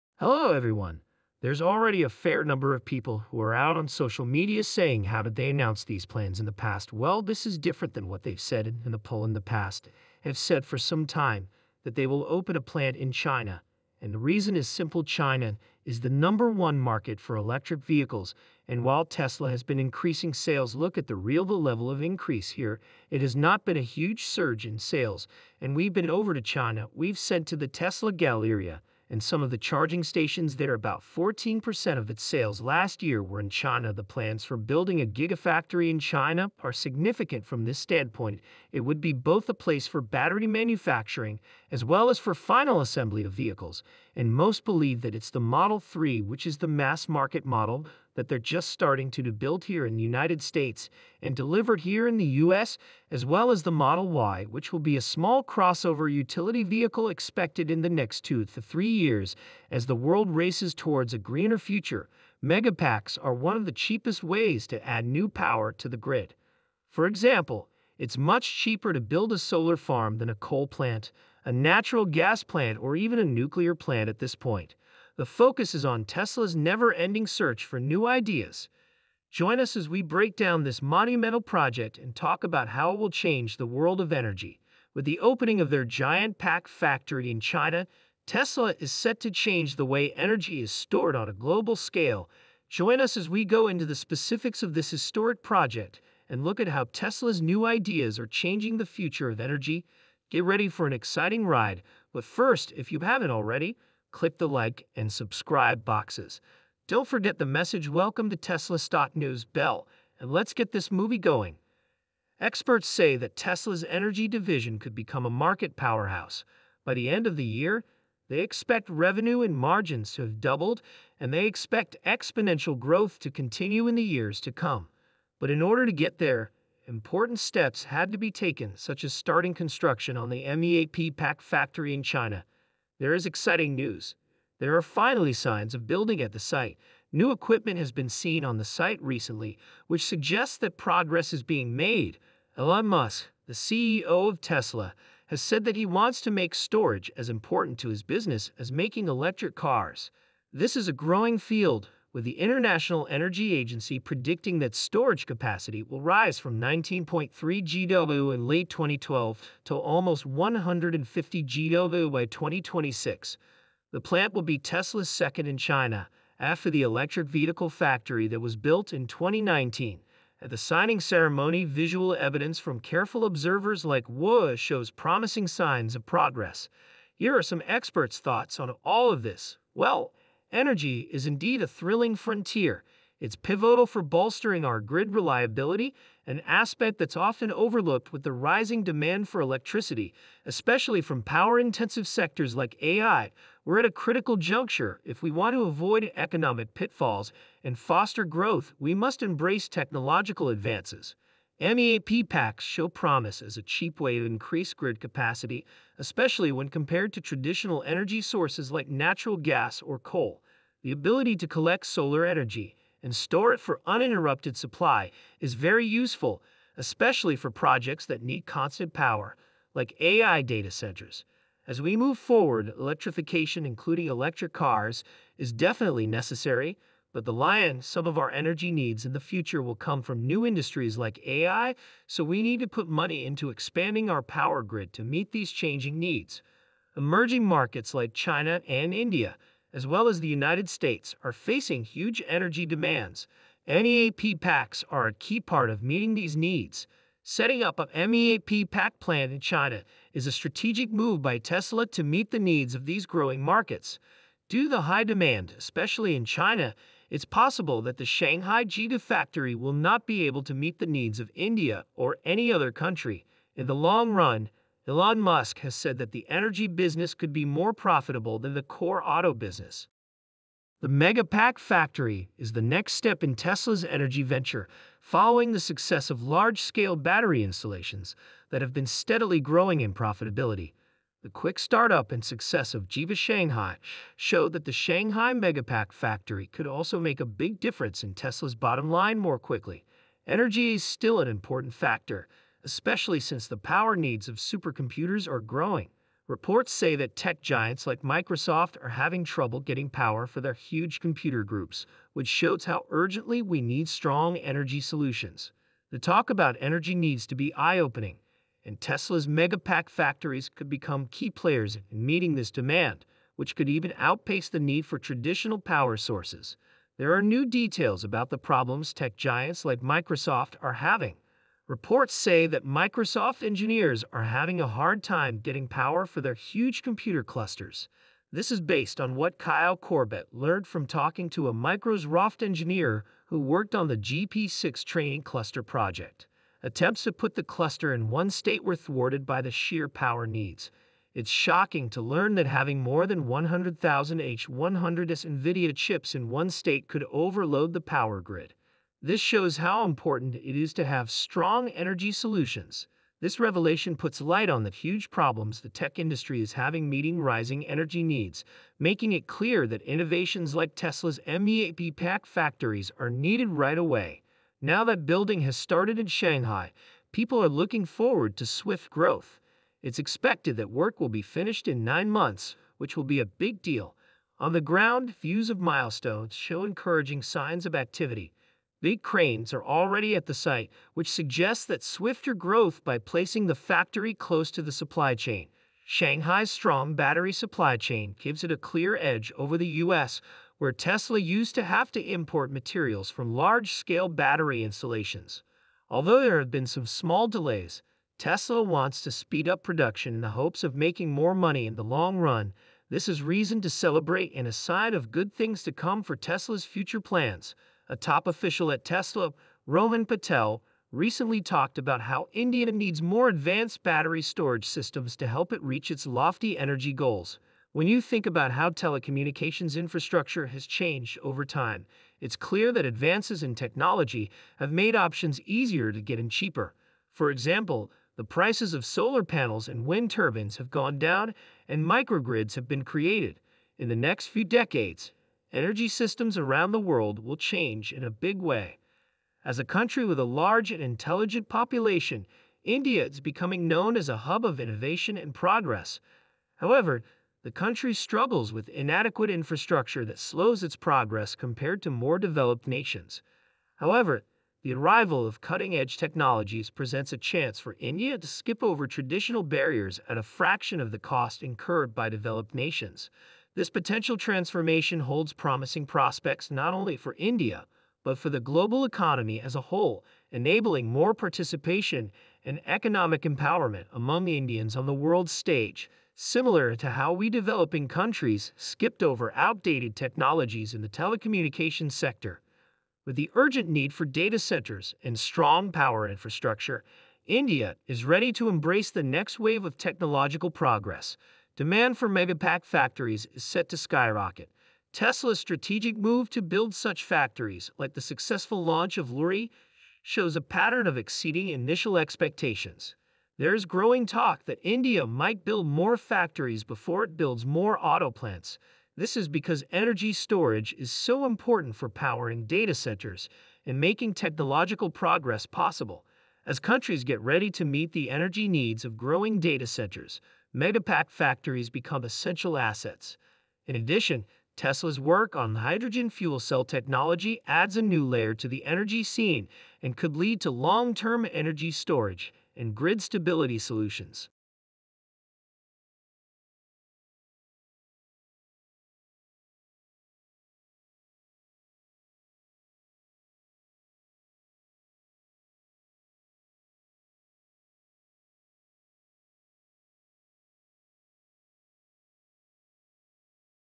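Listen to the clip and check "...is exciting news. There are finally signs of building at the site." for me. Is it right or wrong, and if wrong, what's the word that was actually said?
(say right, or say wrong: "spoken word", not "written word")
right.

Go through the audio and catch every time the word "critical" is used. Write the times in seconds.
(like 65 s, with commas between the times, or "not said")
193 s.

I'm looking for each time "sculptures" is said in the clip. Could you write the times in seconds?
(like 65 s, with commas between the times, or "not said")
not said.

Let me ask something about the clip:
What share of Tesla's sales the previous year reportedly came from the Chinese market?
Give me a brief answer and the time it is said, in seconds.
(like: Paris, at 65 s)
14%, at 31 s.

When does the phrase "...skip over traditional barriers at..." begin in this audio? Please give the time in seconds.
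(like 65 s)
458 s.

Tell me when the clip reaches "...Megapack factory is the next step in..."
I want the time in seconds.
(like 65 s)
270 s.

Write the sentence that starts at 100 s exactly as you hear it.
Get ready for an exciting ride, but first, if you haven't already, click the like and subscribe boxes.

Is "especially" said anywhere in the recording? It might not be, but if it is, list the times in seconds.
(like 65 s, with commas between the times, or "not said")
190 s, 205 s, 216 s, 255 s, 292 s.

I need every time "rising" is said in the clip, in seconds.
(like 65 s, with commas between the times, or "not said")
188 s, 357 s.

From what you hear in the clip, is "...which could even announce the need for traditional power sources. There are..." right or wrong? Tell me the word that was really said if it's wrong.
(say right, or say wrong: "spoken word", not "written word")
wrong: "outpace", not "announce".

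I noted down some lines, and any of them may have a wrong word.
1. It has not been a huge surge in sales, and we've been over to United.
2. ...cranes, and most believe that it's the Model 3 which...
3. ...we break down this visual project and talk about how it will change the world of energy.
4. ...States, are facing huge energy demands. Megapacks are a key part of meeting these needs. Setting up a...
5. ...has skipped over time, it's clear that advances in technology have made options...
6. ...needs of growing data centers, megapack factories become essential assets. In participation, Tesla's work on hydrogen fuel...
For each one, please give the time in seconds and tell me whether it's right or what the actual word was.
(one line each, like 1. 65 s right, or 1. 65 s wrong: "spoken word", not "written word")
1. 23 s wrong: "China", not "United"
2. 43 s wrong: "vehicles", not "cranes"
3. 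79 s wrong: "monumental", not "visual"
4. 240 s right
5. 420 s wrong: "changed", not "skipped"
6. 518 s wrong: "addition", not "participation".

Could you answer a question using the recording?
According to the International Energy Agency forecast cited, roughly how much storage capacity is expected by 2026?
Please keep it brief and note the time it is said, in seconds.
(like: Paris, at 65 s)
150 GW, at 160 s.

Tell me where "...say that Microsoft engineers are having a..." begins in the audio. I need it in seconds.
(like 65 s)
322 s.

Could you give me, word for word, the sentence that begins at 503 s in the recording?
There's growing talk that India might build more factories before it builds more auto plants.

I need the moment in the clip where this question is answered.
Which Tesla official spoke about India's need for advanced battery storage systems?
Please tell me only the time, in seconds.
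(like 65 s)
409 s.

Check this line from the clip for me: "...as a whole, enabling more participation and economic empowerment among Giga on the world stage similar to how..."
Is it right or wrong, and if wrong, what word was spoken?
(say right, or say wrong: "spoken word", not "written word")
wrong: "Indians", not "Giga".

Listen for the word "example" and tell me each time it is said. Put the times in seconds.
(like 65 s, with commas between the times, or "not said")
67 s, 427 s.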